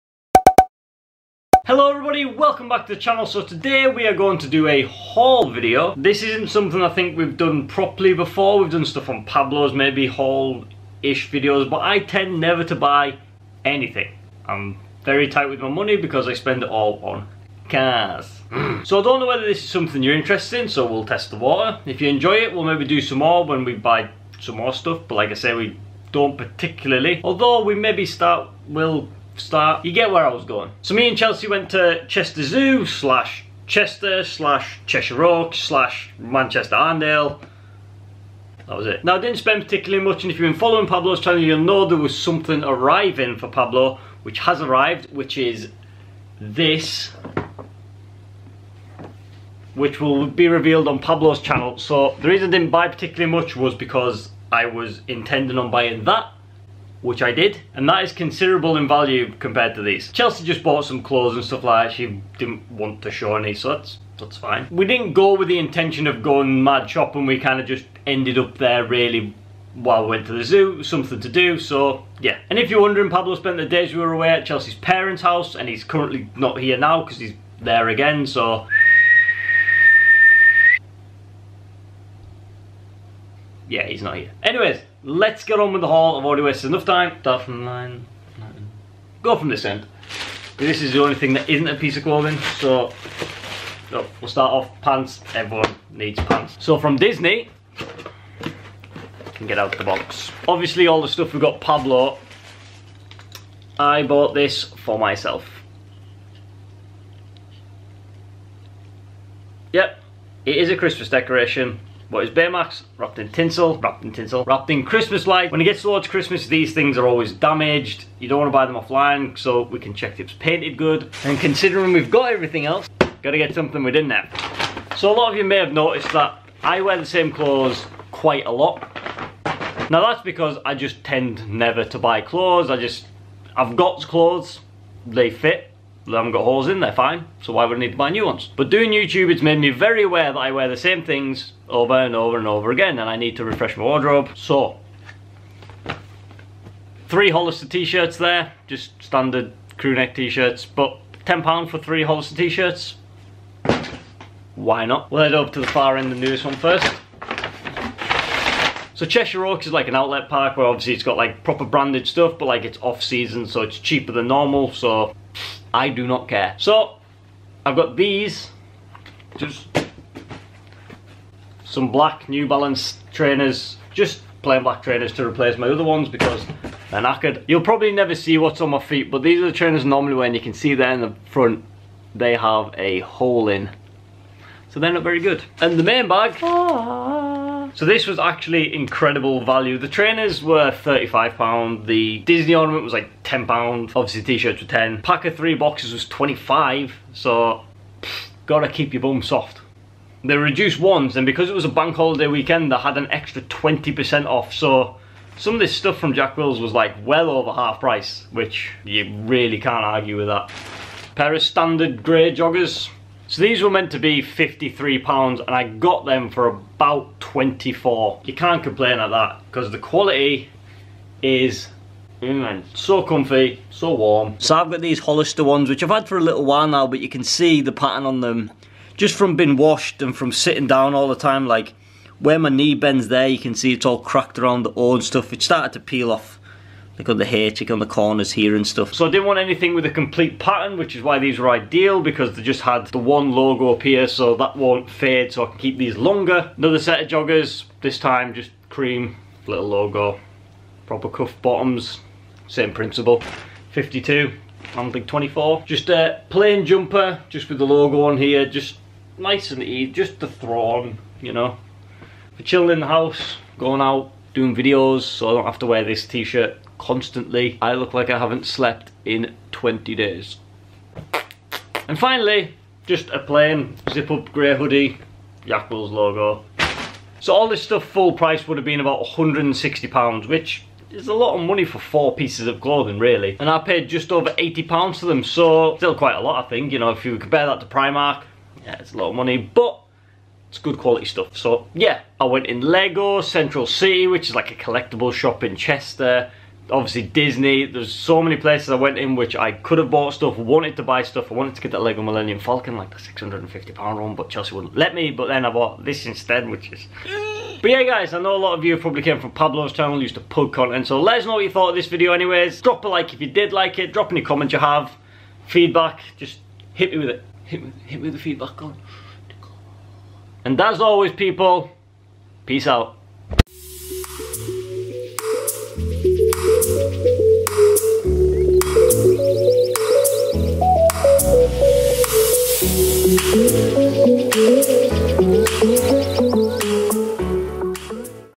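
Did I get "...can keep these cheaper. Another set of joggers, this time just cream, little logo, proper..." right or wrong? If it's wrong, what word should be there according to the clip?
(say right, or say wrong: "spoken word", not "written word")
wrong: "longer", not "cheaper".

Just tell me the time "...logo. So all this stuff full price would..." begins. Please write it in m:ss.
4:35.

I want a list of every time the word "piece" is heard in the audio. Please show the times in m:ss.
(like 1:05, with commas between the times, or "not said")
1:31, 4:42.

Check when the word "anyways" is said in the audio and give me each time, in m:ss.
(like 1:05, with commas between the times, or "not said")
1:24, 5:12.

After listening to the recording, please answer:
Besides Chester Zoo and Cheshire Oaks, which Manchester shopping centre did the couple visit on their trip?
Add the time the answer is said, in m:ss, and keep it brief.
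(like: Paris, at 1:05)
Manchester Arndale, at 0:36.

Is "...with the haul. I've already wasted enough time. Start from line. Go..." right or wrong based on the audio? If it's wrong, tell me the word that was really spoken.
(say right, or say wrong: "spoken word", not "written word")
right.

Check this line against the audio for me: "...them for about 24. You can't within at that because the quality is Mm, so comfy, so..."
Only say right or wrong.
wrong.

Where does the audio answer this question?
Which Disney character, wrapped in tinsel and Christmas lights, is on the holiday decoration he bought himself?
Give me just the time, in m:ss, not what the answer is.
1:52.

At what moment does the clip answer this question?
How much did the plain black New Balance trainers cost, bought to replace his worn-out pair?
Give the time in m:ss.
3:10.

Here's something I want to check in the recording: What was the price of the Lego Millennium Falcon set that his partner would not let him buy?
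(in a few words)
£650.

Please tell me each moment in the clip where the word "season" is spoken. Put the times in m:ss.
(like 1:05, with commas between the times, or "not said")
2:43.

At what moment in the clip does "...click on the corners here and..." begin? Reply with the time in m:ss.
3:57.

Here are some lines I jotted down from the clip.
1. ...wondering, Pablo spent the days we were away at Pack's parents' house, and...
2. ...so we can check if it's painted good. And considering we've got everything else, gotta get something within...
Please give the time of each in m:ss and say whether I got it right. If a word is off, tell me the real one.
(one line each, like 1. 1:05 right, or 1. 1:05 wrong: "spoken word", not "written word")
1. 1:12 wrong: "Chelsey", not "Pack"
2. 1:59 right.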